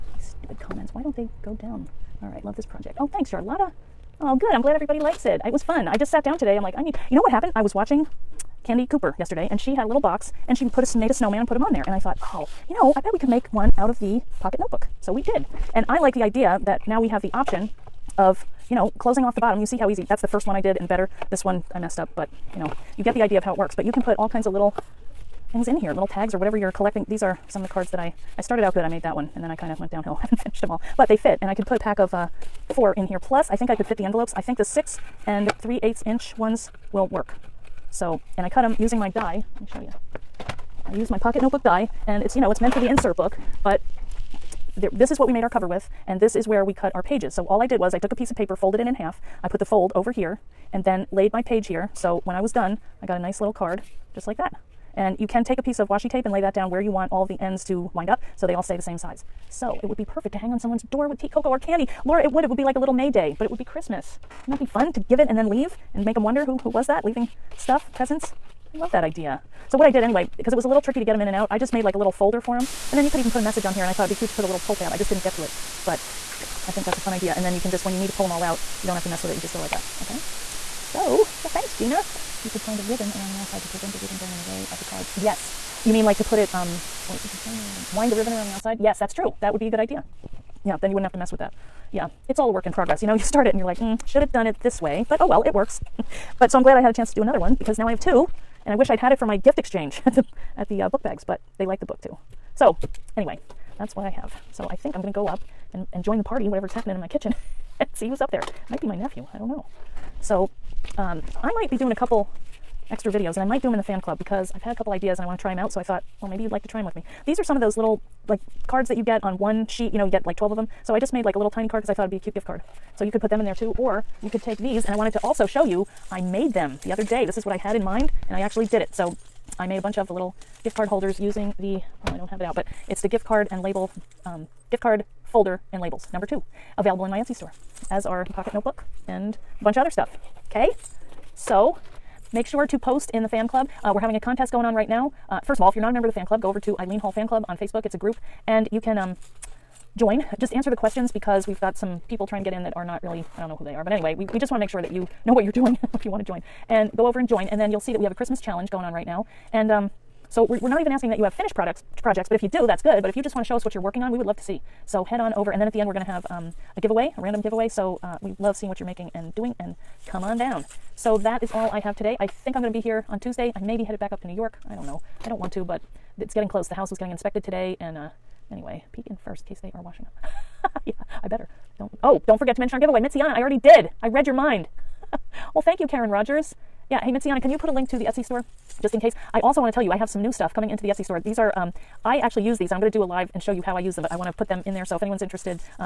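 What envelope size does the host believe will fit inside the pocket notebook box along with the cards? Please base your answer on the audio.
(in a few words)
6 3/8 inch.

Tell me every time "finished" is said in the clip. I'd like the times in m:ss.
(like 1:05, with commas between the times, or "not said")
0:30, 2:41.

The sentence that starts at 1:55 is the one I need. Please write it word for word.
So I thought, well, maybe you'd like to try them with me.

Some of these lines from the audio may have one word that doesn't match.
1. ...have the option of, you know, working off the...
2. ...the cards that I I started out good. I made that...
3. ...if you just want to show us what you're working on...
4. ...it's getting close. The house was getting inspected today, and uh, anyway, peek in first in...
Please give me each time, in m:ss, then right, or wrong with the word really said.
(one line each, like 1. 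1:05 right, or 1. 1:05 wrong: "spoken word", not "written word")
1. 0:17 wrong: "closing", not "working"
2. 0:27 right
3. 2:43 right
4. 2:56 right.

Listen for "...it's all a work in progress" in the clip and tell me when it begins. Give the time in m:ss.
1:32.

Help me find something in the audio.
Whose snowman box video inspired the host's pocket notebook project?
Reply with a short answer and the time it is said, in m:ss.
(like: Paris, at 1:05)
Candy Cooper, at 0:08.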